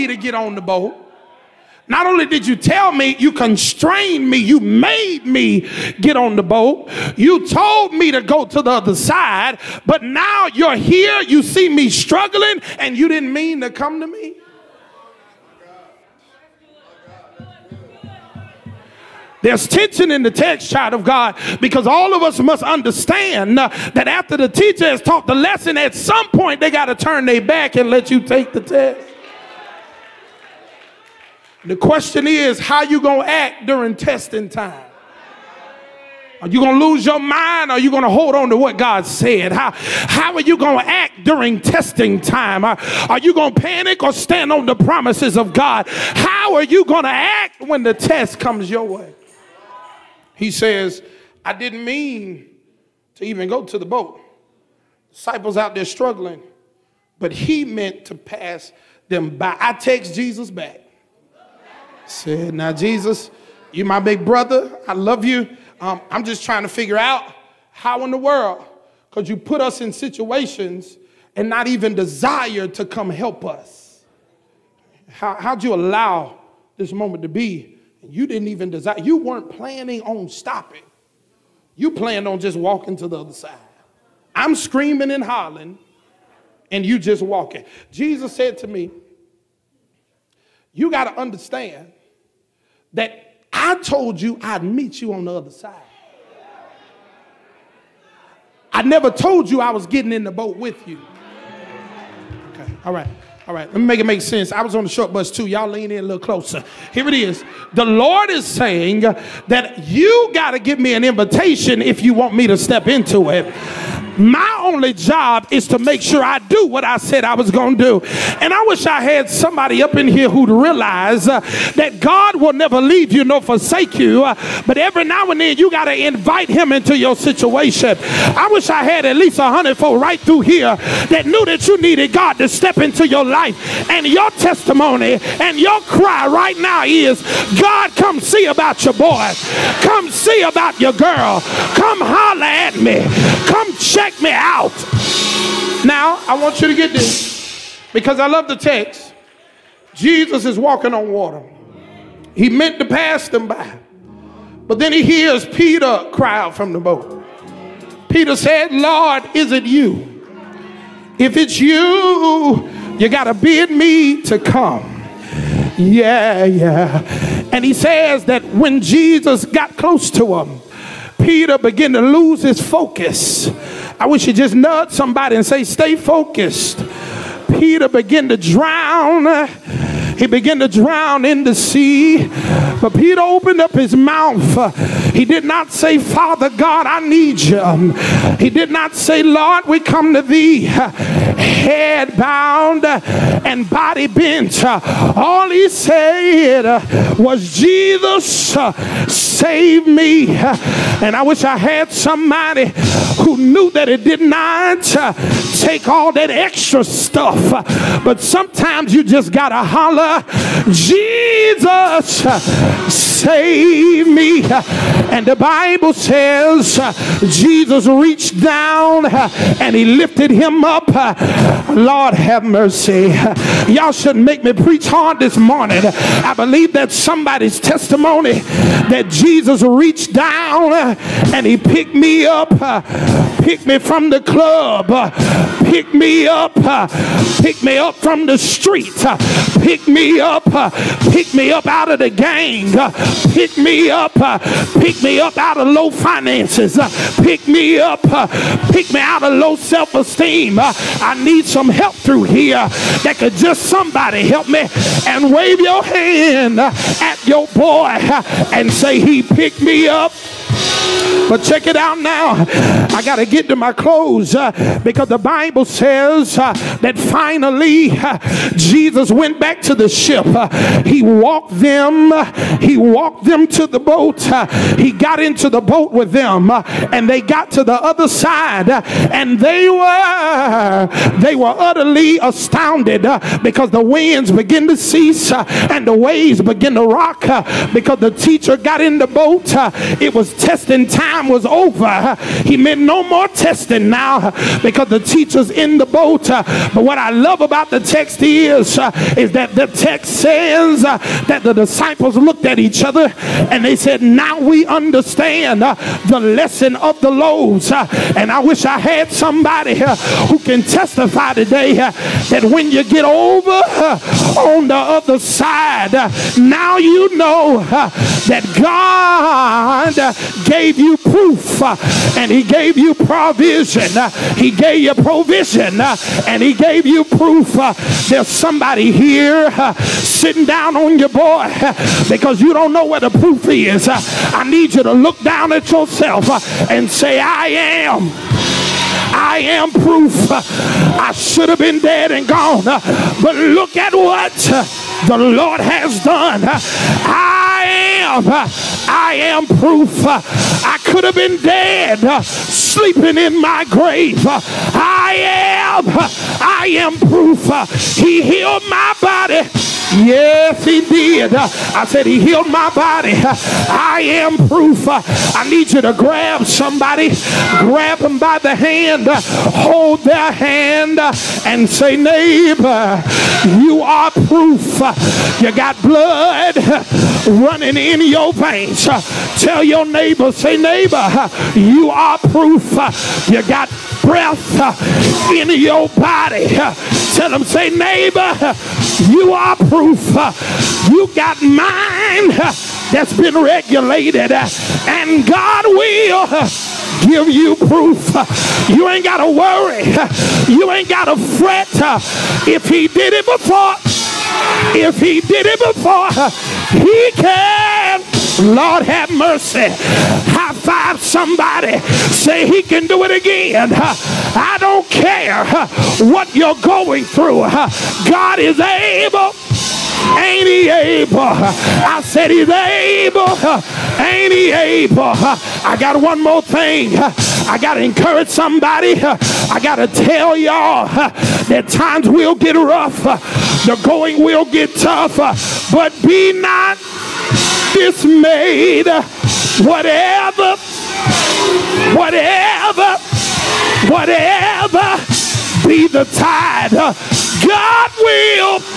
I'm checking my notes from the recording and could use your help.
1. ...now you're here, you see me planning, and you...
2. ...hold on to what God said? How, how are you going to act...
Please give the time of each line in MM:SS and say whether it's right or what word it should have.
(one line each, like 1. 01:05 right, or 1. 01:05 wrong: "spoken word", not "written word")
1. 00:10 wrong: "struggling", not "planning"
2. 00:38 right.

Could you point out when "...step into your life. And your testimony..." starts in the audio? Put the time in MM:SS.
02:12.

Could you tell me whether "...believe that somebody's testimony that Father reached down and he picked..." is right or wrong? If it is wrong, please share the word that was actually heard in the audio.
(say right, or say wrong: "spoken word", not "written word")
wrong: "Jesus", not "Father".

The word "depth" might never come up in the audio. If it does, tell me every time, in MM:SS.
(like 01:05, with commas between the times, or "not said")
not said.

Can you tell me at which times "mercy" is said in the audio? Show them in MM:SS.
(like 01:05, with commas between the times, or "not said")
03:42, 06:49.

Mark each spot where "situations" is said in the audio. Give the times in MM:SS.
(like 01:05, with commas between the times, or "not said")
01:09, 02:07.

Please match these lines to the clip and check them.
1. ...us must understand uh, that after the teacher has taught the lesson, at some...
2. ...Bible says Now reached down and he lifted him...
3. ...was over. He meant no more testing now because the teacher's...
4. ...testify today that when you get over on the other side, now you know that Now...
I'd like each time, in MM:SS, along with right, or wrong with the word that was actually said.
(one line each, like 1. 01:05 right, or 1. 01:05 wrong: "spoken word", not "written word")
1. 00:22 right
2. 03:35 wrong: "Jesus", not "Now"
3. 04:51 right
4. 05:10 wrong: "God", not "Now".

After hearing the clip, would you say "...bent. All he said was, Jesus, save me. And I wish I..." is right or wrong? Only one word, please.
right.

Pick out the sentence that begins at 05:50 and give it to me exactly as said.
I could have been dead, sleeping in my grave.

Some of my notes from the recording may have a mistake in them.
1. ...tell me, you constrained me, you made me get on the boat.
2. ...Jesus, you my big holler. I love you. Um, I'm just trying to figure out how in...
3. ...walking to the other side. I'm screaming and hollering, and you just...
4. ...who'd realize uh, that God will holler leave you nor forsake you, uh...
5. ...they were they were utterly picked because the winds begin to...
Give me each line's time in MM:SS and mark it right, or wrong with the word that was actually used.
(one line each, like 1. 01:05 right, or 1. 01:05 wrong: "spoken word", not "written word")
1. 00:02 right
2. 01:02 wrong: "brother", not "holler"
3. 01:22 right
4. 02:00 wrong: "never", not "holler"
5. 04:39 wrong: "astounded", not "picked".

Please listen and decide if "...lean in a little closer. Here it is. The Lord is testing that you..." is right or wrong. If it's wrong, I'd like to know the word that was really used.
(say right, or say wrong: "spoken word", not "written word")
wrong: "saying", not "testing".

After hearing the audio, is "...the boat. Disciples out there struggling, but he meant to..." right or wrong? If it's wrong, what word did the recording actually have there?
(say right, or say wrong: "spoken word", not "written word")
right.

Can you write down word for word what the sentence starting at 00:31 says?
The question is, how you gonna act during testing time?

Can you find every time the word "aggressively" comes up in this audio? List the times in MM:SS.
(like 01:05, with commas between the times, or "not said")
not said.